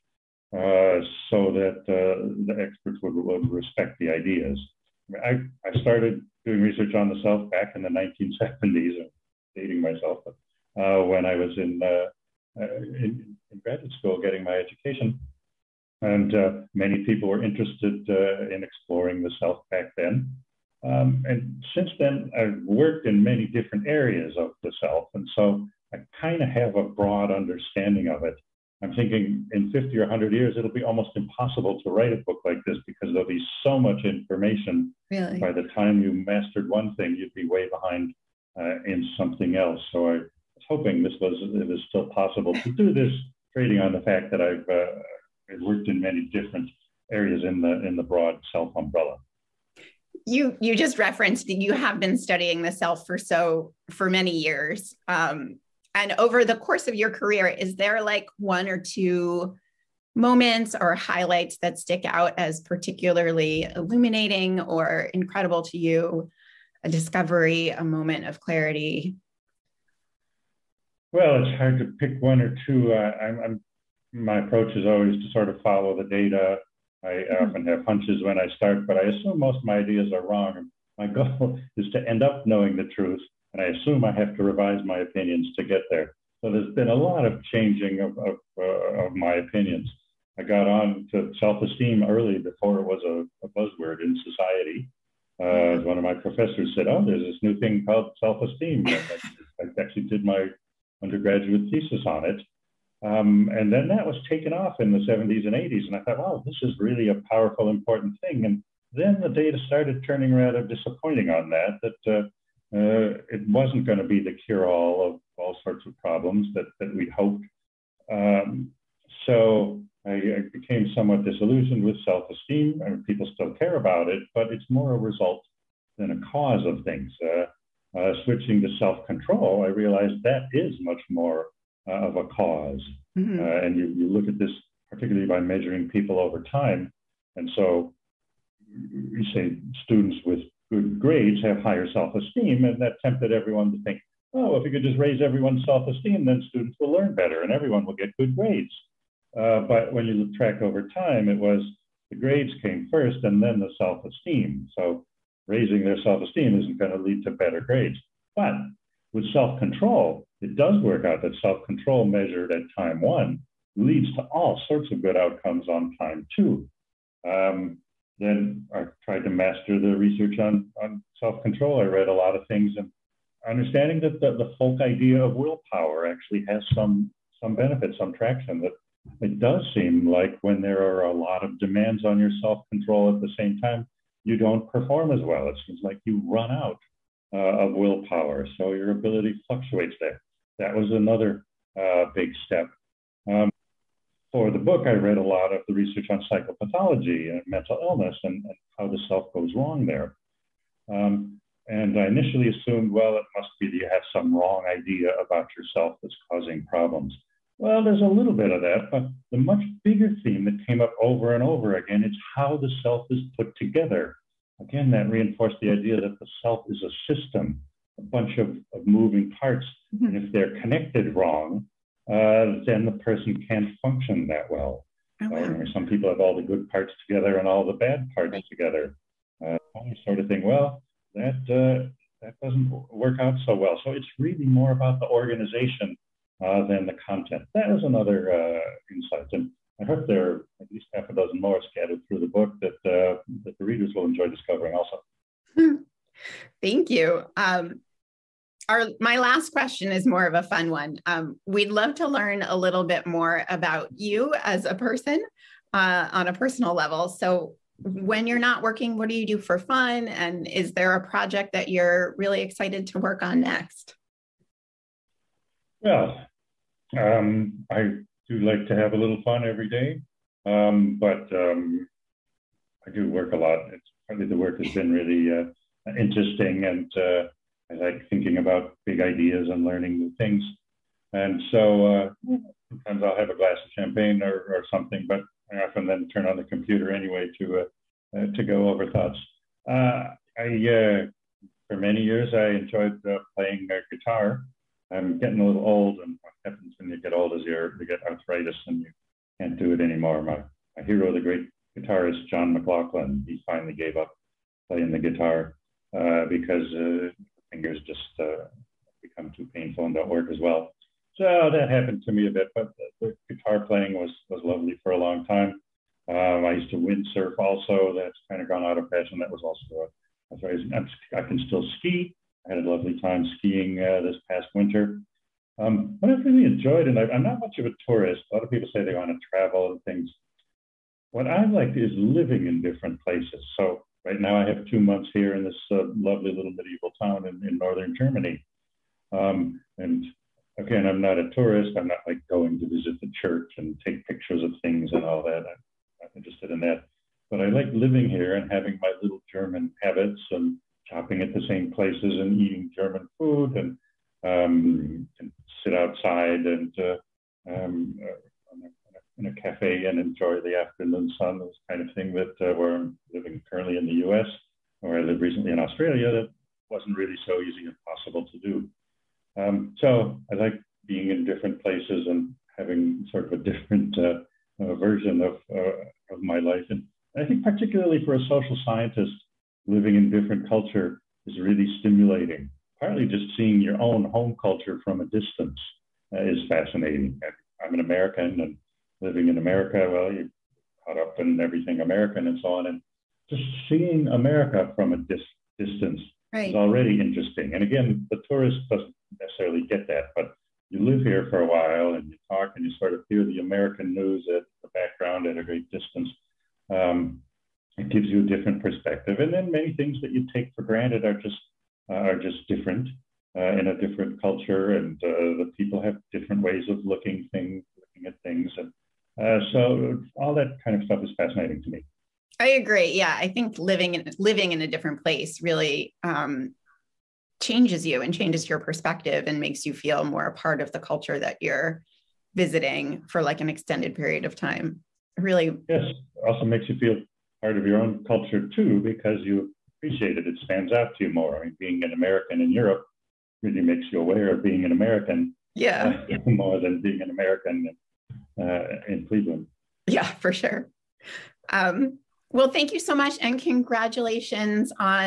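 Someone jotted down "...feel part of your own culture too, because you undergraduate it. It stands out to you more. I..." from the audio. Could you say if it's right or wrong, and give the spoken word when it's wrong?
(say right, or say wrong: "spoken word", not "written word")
wrong: "appreciate", not "undergraduate".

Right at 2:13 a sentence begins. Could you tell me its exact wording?
uh, and you, you look at this particularly by measuring people over time.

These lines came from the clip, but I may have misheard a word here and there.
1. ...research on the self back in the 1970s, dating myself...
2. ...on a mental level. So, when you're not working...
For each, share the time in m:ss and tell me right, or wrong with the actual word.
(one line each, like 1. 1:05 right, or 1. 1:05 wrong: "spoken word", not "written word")
1. 0:06 right
2. 4:16 wrong: "personal", not "mental".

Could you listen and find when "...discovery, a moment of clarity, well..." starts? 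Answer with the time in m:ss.
1:06.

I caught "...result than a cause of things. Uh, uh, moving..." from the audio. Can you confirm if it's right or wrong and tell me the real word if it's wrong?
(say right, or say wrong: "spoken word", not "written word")
wrong: "switching", not "moving".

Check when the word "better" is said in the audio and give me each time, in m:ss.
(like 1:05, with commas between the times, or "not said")
2:27, 2:37.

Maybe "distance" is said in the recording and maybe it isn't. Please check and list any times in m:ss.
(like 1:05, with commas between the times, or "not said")
6:25, 6:35, 6:45.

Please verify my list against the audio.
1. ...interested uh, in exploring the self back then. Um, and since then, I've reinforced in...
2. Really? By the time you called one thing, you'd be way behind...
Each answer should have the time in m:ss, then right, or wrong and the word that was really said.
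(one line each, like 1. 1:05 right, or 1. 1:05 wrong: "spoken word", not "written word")
1. 0:17 wrong: "worked", not "reinforced"
2. 0:35 wrong: "mastered", not "called".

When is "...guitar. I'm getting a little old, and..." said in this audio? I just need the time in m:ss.
4:53.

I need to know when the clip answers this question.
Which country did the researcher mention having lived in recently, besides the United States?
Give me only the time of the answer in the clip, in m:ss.
6:05.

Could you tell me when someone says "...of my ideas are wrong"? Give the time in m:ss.
1:19.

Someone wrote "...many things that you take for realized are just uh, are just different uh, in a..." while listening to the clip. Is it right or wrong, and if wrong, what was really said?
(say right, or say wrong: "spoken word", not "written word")
wrong: "granted", not "realized".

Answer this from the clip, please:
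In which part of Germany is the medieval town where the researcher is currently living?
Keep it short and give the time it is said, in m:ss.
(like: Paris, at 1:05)
Northern Germany, at 5:37.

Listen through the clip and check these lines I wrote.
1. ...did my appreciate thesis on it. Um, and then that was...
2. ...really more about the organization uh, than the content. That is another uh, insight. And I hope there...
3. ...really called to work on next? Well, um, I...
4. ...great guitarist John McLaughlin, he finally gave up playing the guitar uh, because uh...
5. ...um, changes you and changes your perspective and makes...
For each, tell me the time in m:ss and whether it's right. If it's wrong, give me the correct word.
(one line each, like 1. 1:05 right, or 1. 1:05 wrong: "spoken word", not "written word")
1. 1:40 wrong: "undergraduate", not "appreciate"
2. 3:54 right
3. 4:22 wrong: "excited", not "called"
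4. 5:01 right
5. 7:06 right.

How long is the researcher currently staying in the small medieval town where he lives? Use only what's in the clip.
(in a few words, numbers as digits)
2 months.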